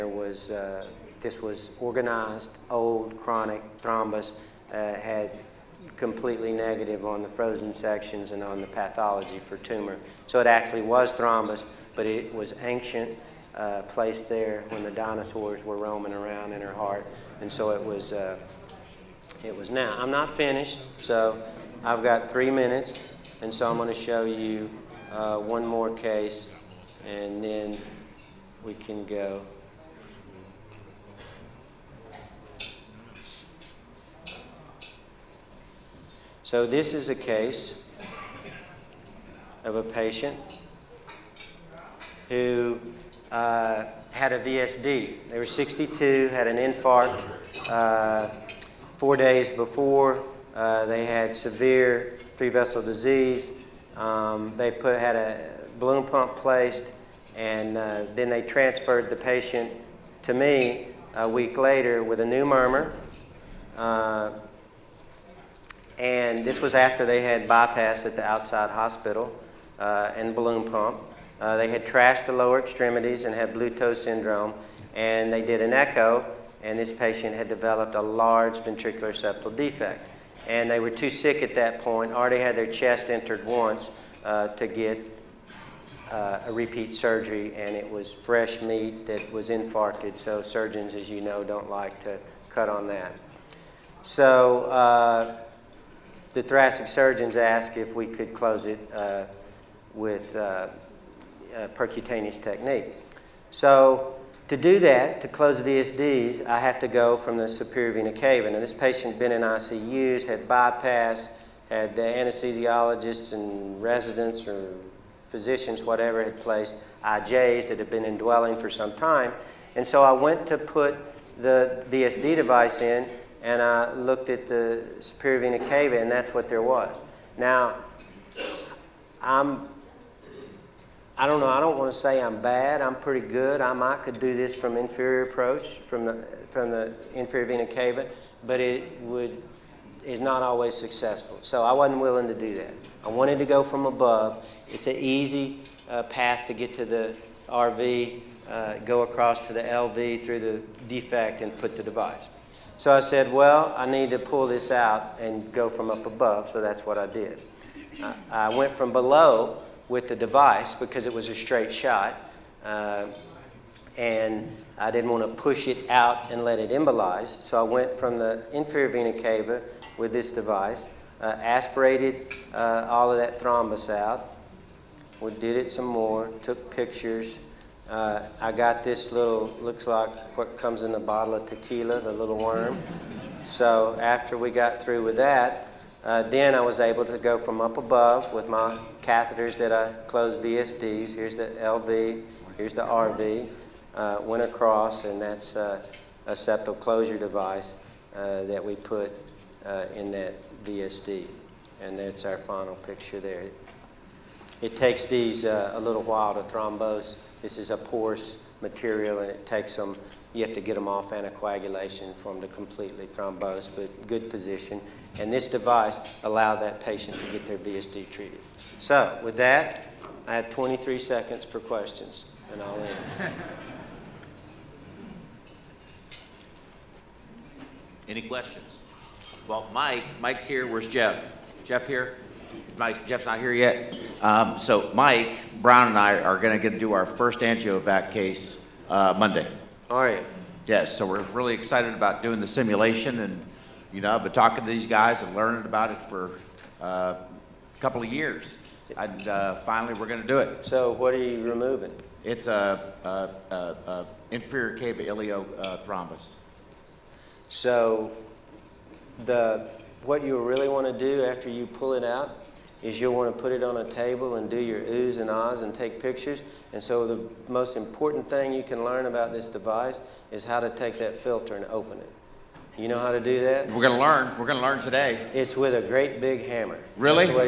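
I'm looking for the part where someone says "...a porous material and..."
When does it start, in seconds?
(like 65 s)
207 s.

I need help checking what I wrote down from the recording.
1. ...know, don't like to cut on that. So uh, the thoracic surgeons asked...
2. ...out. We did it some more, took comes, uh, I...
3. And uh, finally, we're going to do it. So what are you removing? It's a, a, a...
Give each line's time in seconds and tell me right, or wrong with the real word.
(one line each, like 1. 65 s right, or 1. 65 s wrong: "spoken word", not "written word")
1. 91 s right
2. 173 s wrong: "pictures", not "comes"
3. 248 s right.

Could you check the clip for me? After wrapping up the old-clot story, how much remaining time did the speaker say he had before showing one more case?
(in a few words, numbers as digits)
3 minutes.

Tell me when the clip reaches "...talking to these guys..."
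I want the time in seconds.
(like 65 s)
244 s.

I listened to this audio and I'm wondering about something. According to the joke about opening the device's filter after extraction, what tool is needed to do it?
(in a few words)
A great big hammer.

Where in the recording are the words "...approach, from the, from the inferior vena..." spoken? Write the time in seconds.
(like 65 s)
135 s.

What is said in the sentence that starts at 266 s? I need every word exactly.
And so the most important thing you can learn about this device is how to take that filter and open it.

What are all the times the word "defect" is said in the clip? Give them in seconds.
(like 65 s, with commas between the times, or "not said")
79 s, 150 s.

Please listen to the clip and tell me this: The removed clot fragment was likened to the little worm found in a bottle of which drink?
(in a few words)
Tequila.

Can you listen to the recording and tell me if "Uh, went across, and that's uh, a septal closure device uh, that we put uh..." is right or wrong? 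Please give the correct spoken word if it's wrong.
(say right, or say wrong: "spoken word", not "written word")
right.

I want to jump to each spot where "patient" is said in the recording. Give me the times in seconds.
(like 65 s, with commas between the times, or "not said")
39 s, 59 s, 76 s, 108 s, 216 s.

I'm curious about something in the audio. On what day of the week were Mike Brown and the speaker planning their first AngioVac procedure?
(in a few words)
Monday.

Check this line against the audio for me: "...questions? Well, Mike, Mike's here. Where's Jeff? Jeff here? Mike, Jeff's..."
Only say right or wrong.
right.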